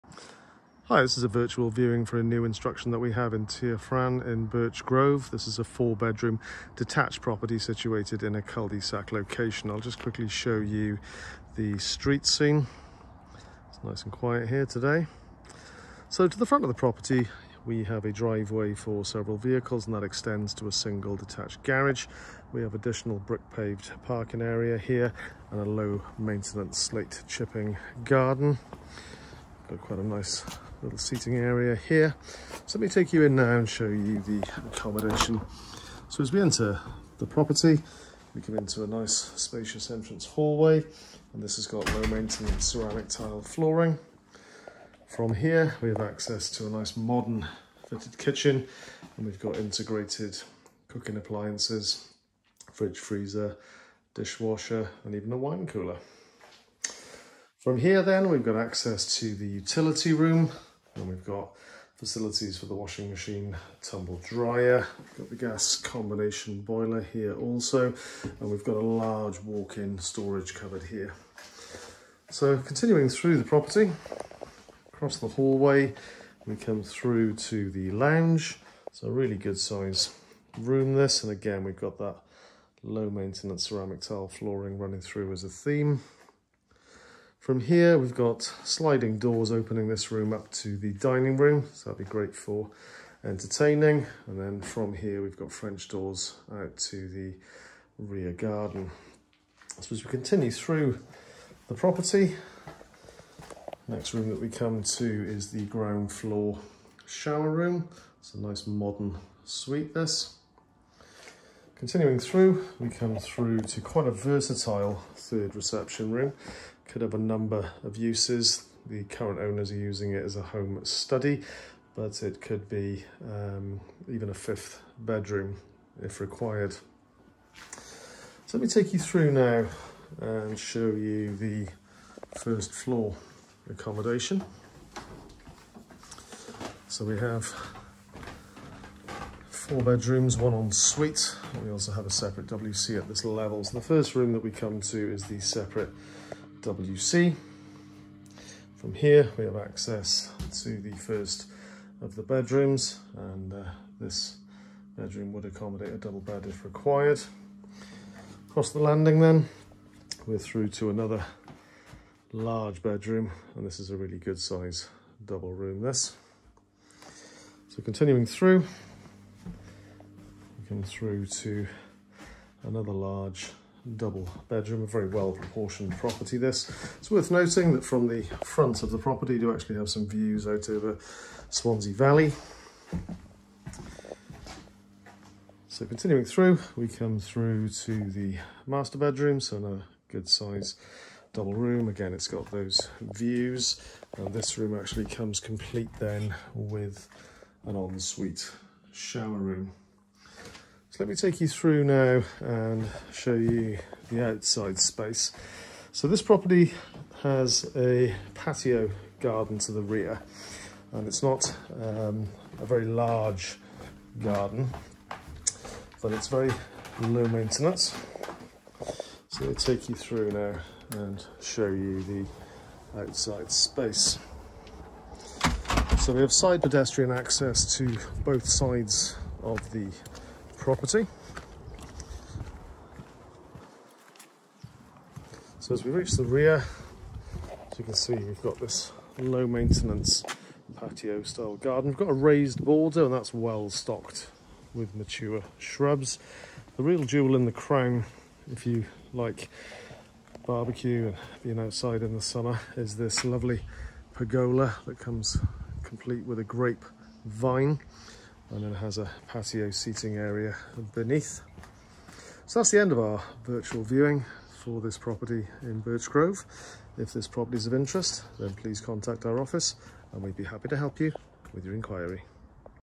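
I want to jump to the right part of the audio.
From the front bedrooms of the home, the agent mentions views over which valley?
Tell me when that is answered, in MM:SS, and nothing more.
03:01.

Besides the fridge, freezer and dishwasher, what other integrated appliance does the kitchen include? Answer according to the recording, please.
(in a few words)
Wine cooler.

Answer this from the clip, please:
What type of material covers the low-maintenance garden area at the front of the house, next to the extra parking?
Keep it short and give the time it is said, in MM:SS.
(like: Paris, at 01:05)
Slate chipping, at 00:26.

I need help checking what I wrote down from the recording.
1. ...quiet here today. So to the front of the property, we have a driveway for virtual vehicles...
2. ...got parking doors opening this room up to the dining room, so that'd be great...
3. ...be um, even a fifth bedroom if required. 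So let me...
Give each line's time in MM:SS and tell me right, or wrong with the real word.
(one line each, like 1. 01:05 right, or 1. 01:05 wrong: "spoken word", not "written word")
1. 00:14 wrong: "several", not "virtual"
2. 01:28 wrong: "sliding", not "parking"
3. 02:02 right.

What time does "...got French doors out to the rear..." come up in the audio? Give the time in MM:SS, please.
01:35.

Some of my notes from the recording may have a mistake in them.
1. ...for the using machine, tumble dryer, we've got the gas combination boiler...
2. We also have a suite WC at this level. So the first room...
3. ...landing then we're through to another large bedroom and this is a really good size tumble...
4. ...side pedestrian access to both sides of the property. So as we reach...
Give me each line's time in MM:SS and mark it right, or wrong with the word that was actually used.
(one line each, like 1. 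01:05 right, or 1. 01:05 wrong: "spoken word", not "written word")
1. 01:02 wrong: "washing", not "using"
2. 02:21 wrong: "separate", not "suite"
3. 02:38 wrong: "double", not "tumble"
4. 03:46 right.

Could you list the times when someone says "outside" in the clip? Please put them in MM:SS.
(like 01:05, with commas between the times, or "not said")
03:24, 03:42, 04:11.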